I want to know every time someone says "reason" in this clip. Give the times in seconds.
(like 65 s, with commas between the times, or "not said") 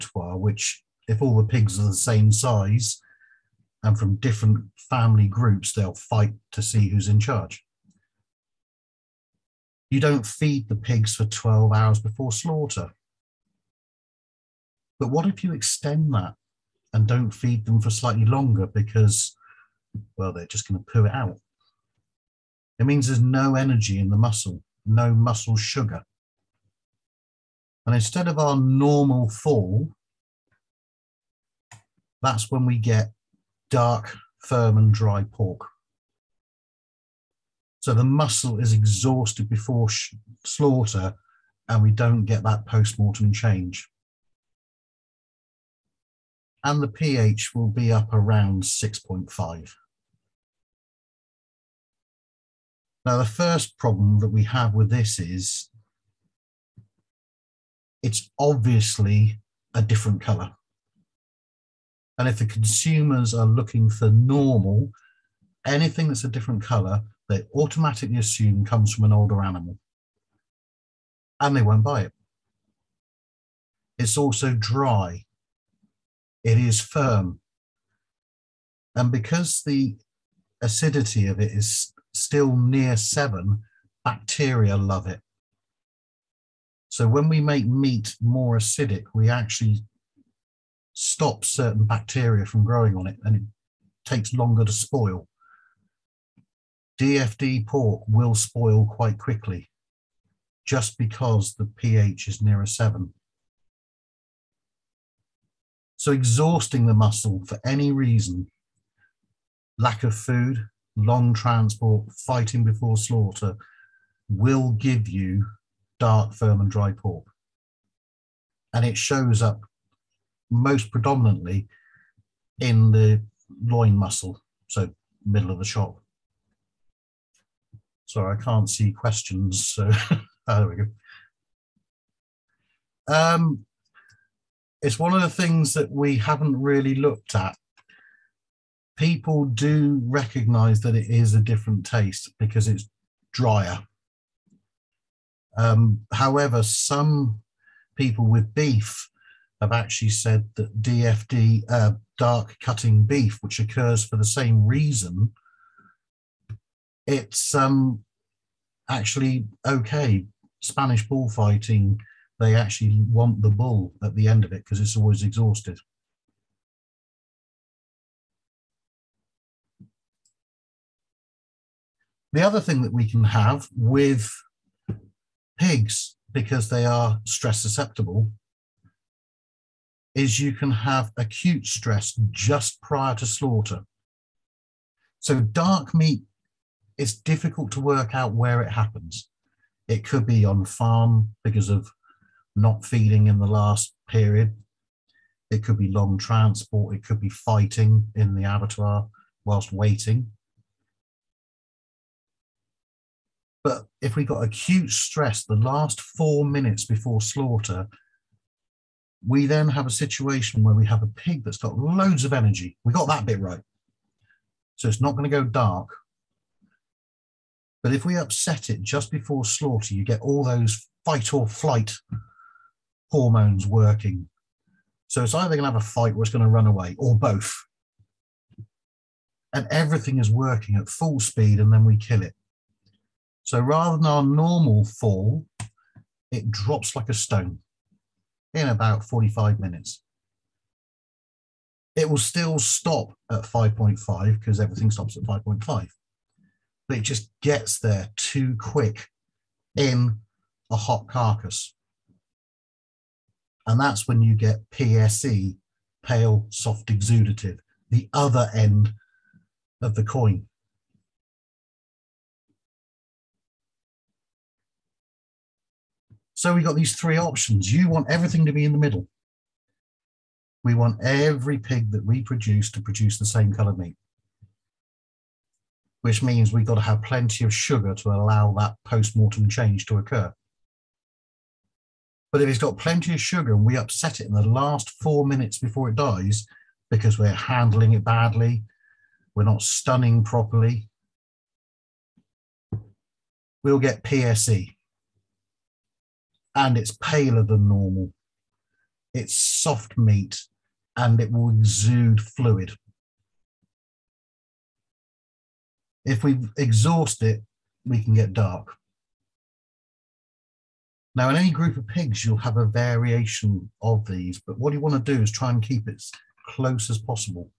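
107 s, 154 s.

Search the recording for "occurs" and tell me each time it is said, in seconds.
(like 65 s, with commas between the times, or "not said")
153 s, 279 s.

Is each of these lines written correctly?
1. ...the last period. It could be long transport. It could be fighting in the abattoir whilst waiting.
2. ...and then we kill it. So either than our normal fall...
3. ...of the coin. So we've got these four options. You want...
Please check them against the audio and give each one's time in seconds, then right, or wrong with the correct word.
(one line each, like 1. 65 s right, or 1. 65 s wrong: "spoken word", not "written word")
1. 193 s right
2. 231 s wrong: "rather", not "either"
3. 259 s wrong: "three", not "four".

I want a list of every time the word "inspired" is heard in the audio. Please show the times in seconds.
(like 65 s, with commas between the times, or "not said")
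not said.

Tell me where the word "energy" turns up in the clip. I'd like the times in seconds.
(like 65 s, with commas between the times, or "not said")
23 s, 212 s.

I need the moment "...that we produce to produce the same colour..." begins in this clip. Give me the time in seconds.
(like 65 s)
271 s.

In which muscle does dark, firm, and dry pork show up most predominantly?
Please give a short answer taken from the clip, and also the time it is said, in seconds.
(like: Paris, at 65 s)
loin muscle, at 123 s.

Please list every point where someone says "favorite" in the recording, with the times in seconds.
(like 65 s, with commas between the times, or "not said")
not said.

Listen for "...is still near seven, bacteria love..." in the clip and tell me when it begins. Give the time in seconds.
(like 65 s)
81 s.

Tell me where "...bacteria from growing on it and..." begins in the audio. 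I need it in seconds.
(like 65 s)
91 s.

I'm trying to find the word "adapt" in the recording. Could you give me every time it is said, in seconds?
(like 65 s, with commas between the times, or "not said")
not said.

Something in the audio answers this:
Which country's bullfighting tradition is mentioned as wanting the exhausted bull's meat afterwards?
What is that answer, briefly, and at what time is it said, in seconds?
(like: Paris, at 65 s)
Spanish, at 160 s.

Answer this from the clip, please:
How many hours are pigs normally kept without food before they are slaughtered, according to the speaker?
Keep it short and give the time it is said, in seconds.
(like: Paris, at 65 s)
12 hours, at 11 s.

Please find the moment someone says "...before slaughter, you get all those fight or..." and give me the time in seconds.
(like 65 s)
219 s.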